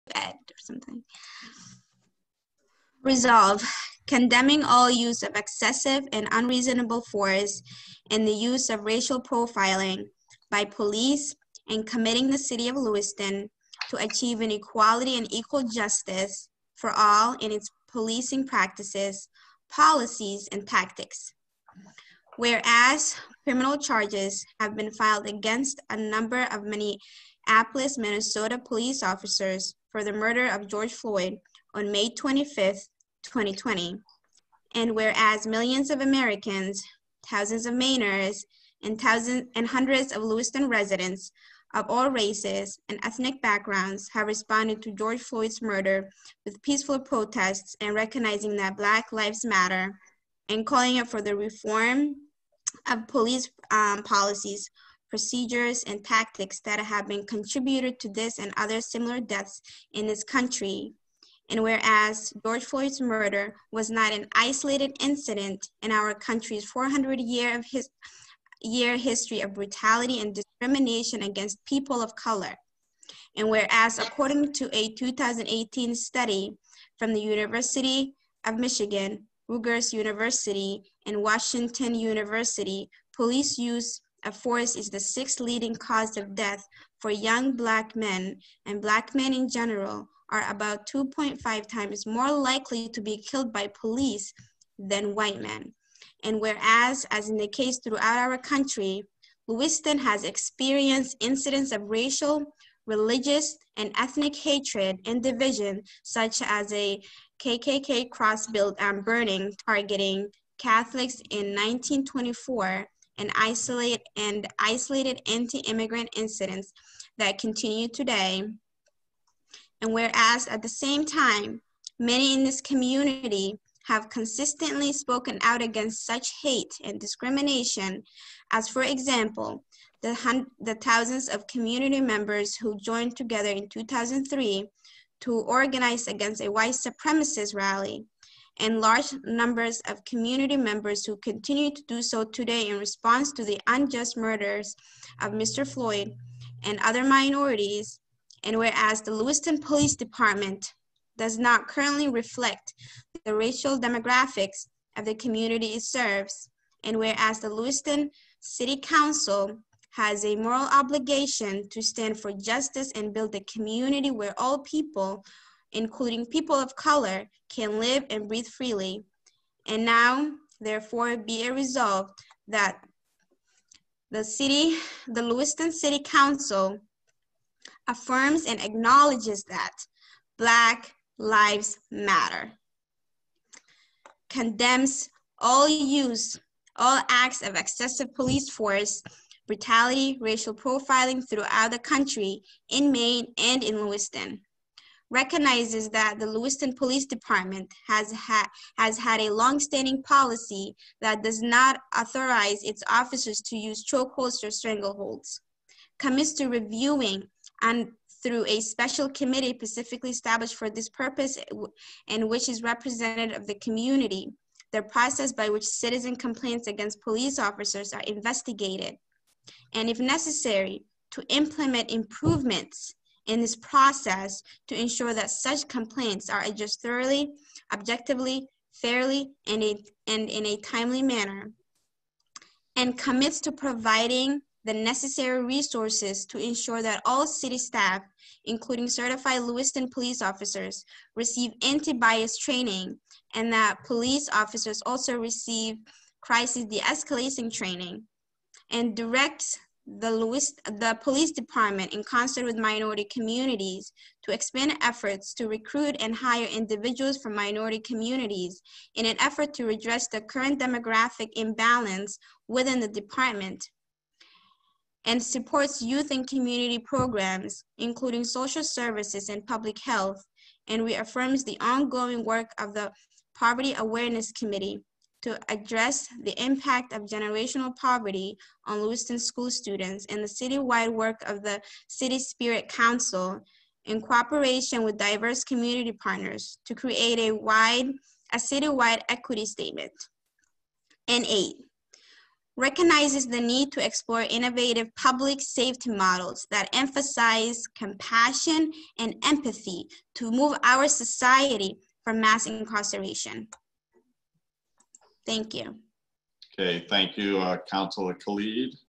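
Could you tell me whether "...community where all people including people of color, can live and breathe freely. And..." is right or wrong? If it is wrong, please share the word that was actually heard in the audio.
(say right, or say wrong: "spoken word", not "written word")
right.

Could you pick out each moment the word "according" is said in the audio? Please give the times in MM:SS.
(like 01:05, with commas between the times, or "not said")
01:13.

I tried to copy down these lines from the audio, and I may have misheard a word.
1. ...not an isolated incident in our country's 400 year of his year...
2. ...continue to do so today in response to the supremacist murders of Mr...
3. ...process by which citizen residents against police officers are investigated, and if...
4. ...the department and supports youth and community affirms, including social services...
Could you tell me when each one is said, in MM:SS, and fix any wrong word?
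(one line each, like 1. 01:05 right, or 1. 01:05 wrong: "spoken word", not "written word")
1. 01:03 right
2. 02:21 wrong: "unjust", not "supremacist"
3. 03:34 wrong: "complaints", not "residents"
4. 04:22 wrong: "programs", not "affirms".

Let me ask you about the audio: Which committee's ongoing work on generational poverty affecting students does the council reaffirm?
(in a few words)
Poverty Awareness Committee.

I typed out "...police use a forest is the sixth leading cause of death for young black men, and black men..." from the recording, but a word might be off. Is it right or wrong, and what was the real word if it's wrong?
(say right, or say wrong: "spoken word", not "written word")
right.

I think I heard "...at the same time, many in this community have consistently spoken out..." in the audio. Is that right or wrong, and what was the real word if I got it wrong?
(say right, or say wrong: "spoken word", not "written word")
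right.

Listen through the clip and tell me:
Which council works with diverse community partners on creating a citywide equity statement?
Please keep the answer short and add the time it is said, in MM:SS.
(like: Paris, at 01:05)
City Spirit Council, at 04:41.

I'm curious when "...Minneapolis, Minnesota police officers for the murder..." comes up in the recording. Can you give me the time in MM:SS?
00:26.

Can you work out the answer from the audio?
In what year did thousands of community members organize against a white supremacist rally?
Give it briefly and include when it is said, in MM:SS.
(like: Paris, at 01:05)
2003, at 02:13.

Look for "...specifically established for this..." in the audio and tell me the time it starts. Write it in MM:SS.
03:29.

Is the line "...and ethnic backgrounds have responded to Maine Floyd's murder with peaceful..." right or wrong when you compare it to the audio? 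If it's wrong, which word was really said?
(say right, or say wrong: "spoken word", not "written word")
wrong: "George", not "Maine".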